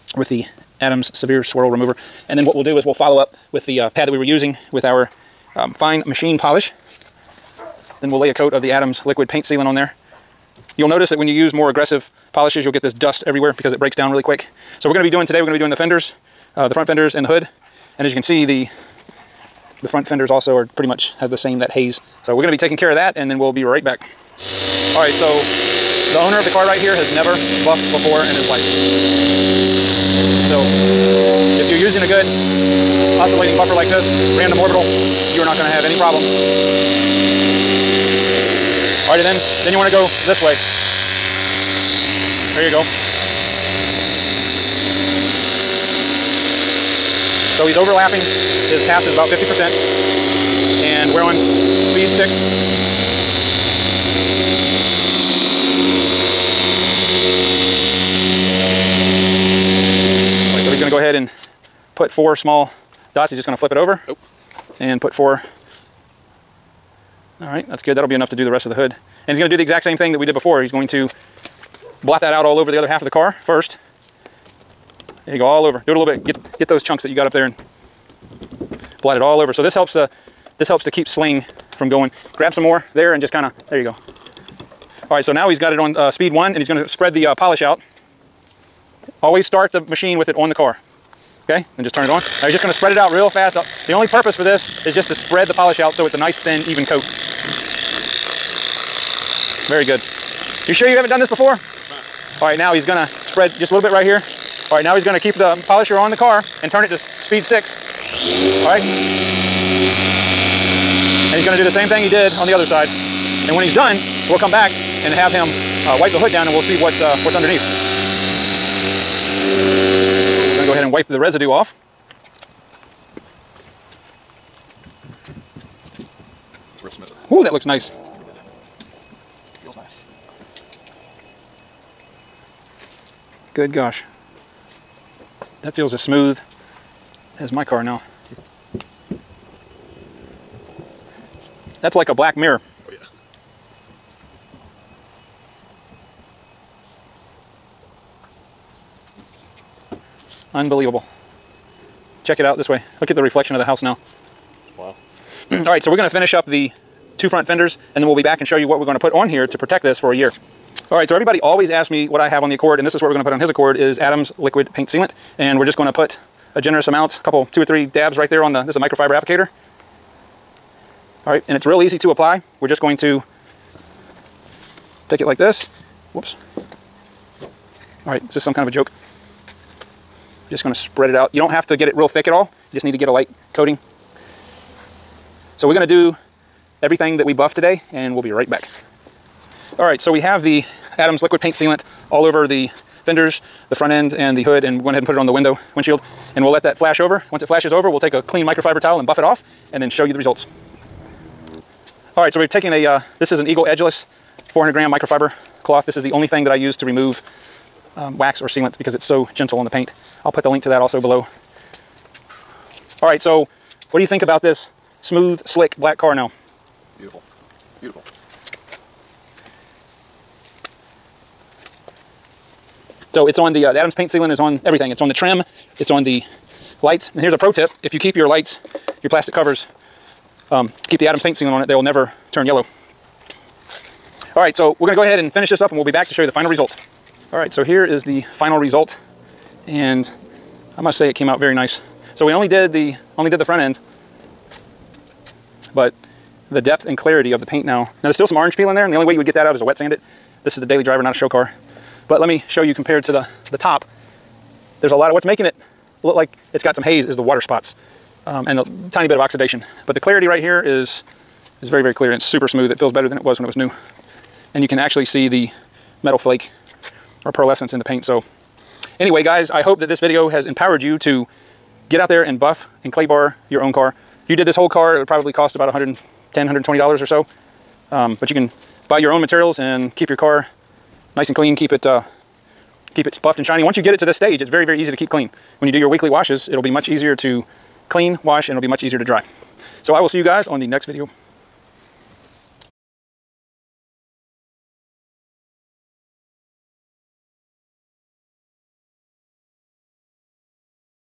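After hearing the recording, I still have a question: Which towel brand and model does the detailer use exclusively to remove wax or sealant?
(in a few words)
Eagle Edgeless 400.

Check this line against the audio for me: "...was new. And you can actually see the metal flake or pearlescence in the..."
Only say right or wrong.
right.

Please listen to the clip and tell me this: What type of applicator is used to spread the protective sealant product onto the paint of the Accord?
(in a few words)
Microfiber applicator.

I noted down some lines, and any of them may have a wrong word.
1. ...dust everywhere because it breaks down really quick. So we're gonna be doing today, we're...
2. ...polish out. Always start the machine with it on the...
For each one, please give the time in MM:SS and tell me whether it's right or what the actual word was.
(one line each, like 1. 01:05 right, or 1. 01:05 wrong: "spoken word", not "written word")
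1. 00:12 right
2. 01:27 right.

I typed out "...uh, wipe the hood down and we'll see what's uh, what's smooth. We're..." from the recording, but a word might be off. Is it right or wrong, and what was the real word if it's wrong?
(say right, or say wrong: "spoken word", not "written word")
wrong: "underneath", not "smooth".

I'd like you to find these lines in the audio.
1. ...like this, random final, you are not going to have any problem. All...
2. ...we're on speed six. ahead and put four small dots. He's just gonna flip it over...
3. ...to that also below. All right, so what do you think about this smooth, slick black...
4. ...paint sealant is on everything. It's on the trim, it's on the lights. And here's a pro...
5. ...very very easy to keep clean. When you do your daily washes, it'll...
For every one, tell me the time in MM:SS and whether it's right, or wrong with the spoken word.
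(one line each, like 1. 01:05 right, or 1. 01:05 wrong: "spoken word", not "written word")
1. 00:33 wrong: "orbital", not "final"
2. 00:51 right
3. 03:30 right
4. 03:43 right
5. 04:44 wrong: "weekly", not "daily".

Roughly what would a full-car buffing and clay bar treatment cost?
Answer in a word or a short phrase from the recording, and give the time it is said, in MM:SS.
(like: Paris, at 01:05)
$110 to $120, at 04:35.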